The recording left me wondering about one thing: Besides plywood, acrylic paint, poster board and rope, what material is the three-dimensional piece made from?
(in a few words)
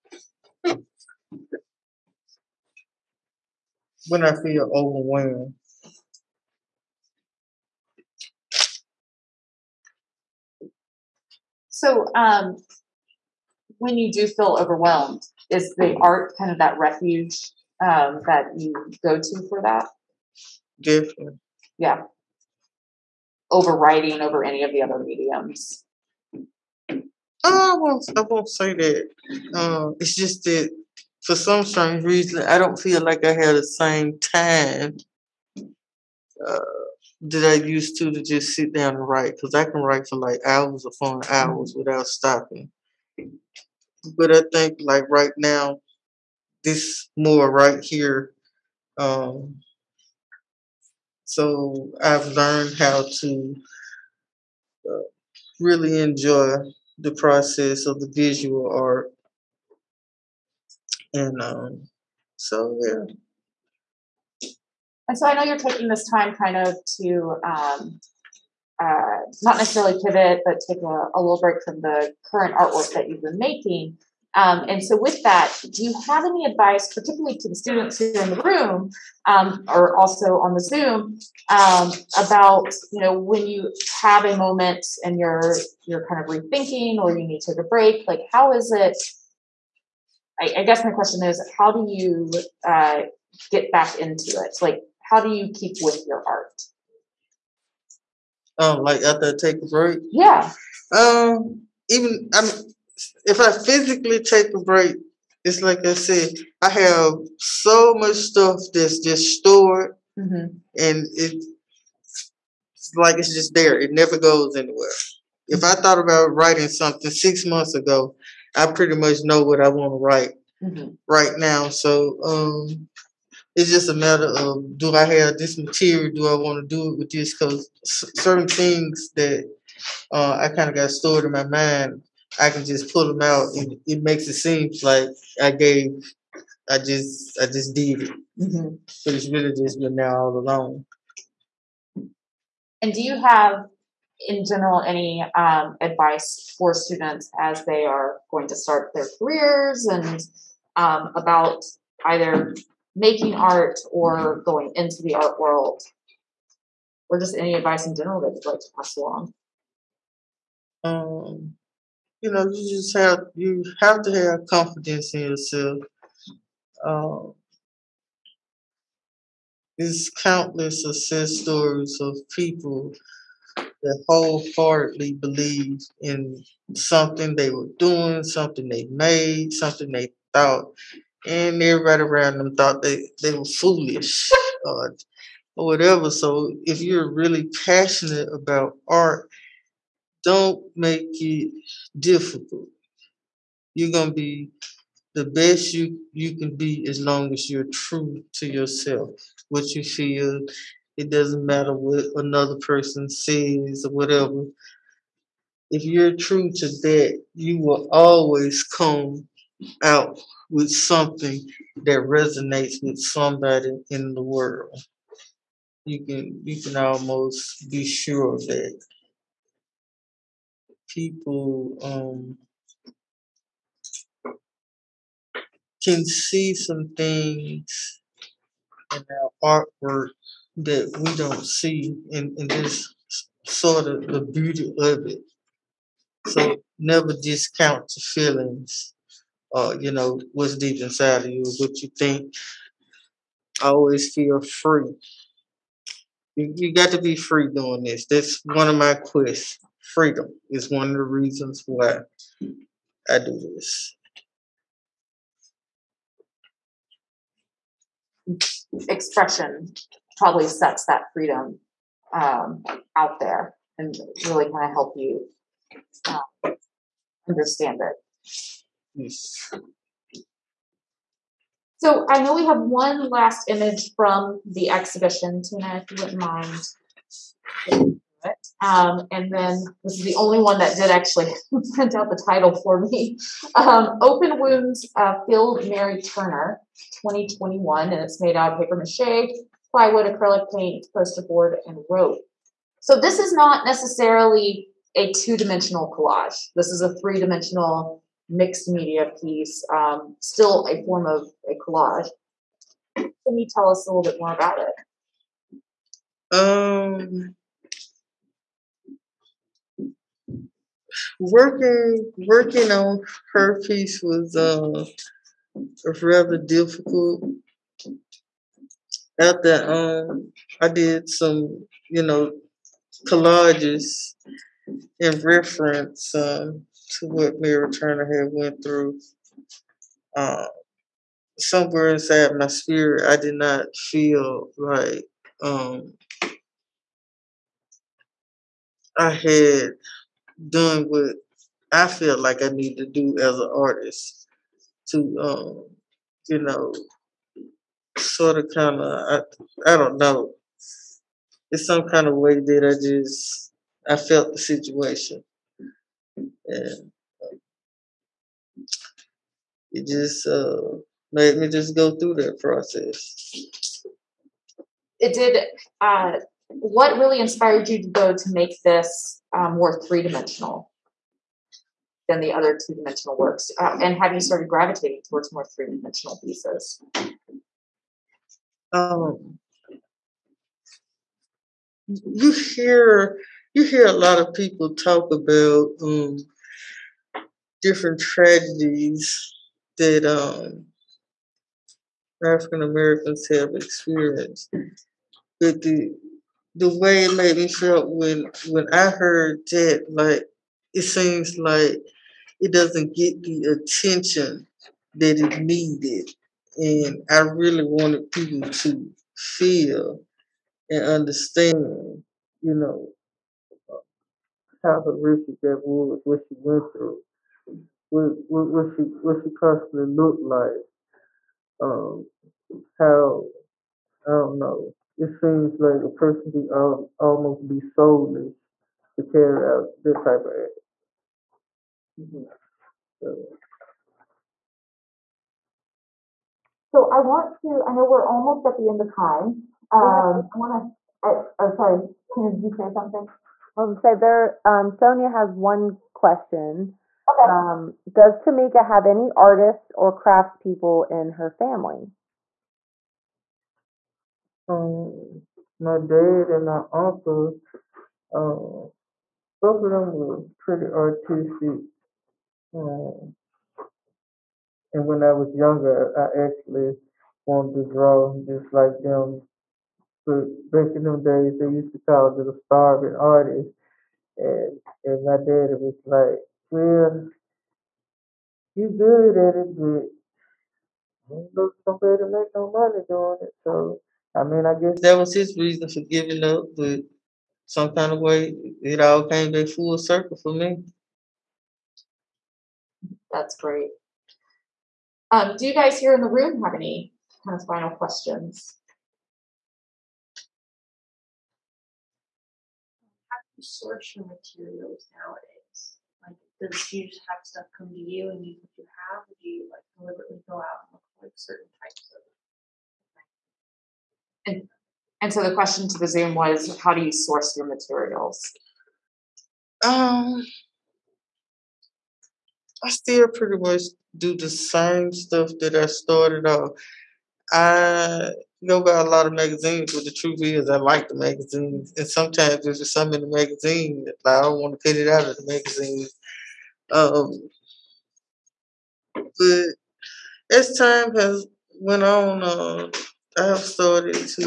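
Paper mache.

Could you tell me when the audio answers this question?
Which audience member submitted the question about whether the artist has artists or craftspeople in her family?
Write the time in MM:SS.
07:24.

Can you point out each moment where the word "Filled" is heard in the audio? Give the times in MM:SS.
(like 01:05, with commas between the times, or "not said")
04:45.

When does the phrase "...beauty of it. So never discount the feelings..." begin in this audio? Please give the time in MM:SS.
03:54.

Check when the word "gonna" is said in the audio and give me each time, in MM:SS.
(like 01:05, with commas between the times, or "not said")
03:13, 07:23.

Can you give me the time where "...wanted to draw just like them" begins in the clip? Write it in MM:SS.
07:47.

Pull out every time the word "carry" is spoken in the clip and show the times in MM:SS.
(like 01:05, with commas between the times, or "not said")
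07:09.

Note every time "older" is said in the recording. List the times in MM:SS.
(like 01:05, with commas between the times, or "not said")
not said.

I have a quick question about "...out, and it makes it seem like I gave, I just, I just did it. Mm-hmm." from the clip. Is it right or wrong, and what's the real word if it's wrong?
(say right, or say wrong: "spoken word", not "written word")
right.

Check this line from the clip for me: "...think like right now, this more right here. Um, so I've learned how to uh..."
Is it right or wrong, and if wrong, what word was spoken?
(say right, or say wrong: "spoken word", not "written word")
right.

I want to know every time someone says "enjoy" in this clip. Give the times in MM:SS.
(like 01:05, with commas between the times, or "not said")
00:55.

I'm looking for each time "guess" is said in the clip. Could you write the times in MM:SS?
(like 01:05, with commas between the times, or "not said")
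01:30, 08:04.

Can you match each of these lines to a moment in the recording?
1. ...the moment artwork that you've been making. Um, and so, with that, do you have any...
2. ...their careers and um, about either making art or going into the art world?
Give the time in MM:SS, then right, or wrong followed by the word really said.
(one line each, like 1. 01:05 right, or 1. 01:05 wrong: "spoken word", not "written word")
1. 01:11 wrong: "current", not "moment"
2. 02:28 right.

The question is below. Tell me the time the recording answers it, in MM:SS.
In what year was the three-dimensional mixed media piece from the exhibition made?
04:47.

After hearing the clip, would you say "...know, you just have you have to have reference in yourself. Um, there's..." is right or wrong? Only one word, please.
wrong.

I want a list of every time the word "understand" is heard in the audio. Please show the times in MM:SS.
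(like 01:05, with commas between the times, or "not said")
04:27, 06:50.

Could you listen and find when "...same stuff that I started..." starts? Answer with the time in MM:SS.
08:44.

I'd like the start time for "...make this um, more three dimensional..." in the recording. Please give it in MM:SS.
06:08.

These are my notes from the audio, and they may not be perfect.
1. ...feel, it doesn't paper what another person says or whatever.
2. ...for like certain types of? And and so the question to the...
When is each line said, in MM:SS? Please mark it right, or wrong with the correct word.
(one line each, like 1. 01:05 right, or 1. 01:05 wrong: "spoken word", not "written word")
1. 03:19 wrong: "matter", not "paper"
2. 08:30 right.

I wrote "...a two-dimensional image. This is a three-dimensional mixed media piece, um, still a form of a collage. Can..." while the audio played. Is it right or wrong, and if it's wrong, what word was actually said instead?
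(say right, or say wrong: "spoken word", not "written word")
wrong: "collage", not "image".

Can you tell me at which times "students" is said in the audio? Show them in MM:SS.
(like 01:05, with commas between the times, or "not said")
01:17, 02:26.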